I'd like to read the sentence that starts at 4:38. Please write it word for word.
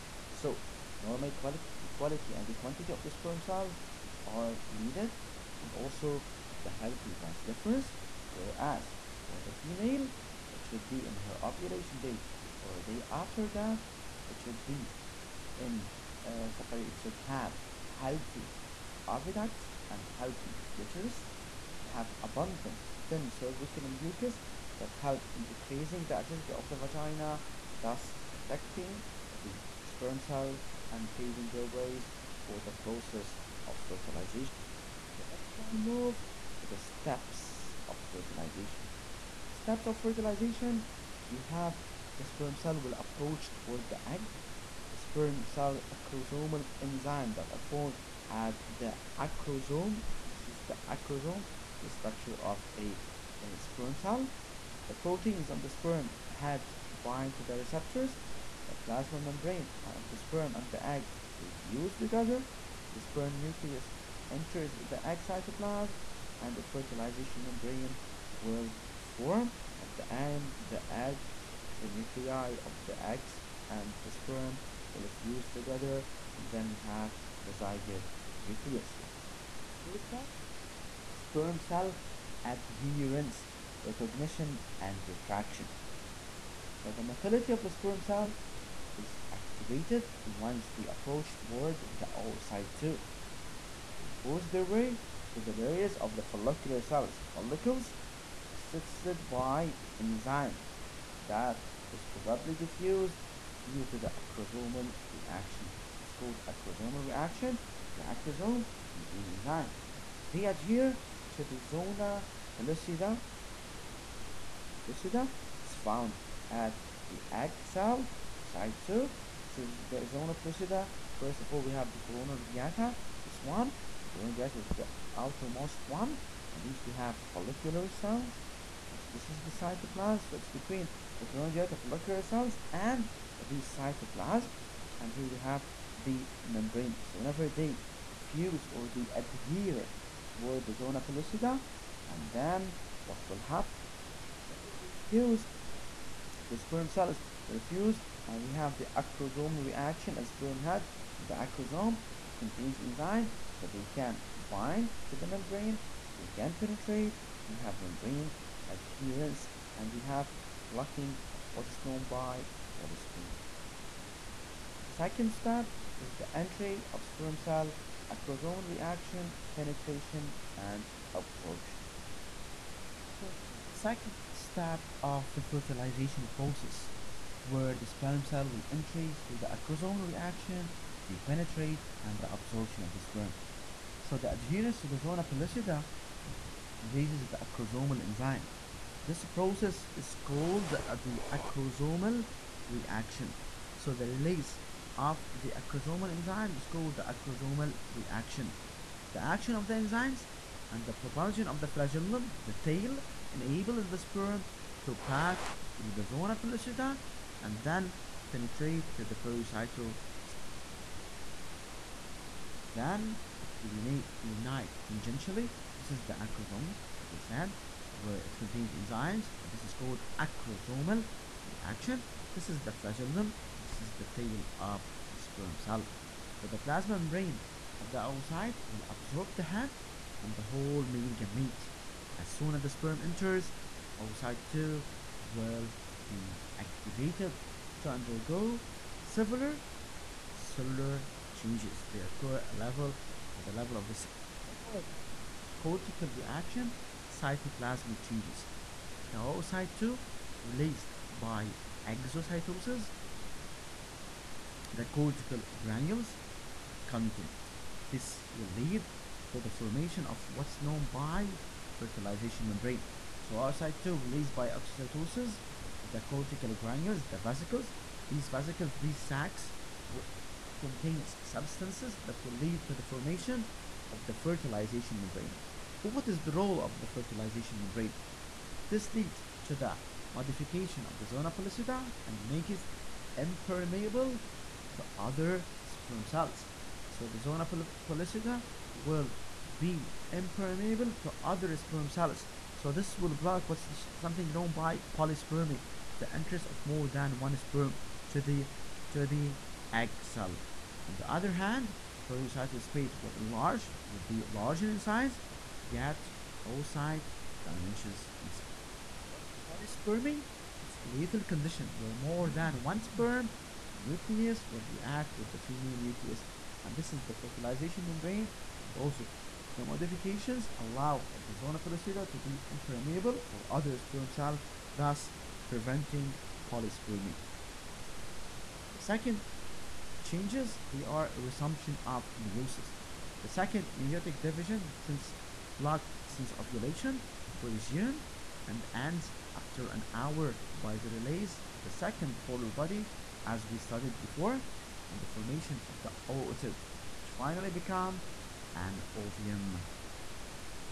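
This leads to the modification of the zona pellucida and makes it impermeable to other sperm cells.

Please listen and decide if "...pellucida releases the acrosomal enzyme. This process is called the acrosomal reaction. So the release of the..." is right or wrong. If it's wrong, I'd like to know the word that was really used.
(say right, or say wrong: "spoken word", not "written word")
right.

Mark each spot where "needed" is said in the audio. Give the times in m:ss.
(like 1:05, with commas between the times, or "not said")
0:04.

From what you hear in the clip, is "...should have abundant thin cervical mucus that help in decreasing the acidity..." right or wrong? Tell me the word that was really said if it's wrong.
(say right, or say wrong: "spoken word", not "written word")
right.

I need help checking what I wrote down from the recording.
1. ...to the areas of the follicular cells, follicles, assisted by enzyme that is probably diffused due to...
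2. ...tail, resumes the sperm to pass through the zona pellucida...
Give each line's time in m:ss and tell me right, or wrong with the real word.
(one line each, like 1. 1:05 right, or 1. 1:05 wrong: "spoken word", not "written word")
1. 1:35 right
2. 3:22 wrong: "enables", not "resumes".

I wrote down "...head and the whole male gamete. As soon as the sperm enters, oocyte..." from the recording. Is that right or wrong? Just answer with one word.
right.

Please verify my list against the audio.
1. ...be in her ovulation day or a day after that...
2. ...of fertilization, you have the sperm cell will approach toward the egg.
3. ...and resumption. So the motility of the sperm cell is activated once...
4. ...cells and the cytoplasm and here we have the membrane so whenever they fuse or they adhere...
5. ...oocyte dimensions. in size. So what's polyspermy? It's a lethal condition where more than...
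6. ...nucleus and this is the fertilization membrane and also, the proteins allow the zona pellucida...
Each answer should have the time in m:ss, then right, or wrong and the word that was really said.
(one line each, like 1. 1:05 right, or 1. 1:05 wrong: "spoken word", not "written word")
1. 0:10 right
2. 0:39 right
3. 1:24 wrong: "retraction", not "resumption"
4. 2:12 right
5. 5:06 right
6. 5:15 wrong: "modifications", not "proteins".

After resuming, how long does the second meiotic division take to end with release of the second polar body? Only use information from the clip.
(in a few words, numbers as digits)
an hour.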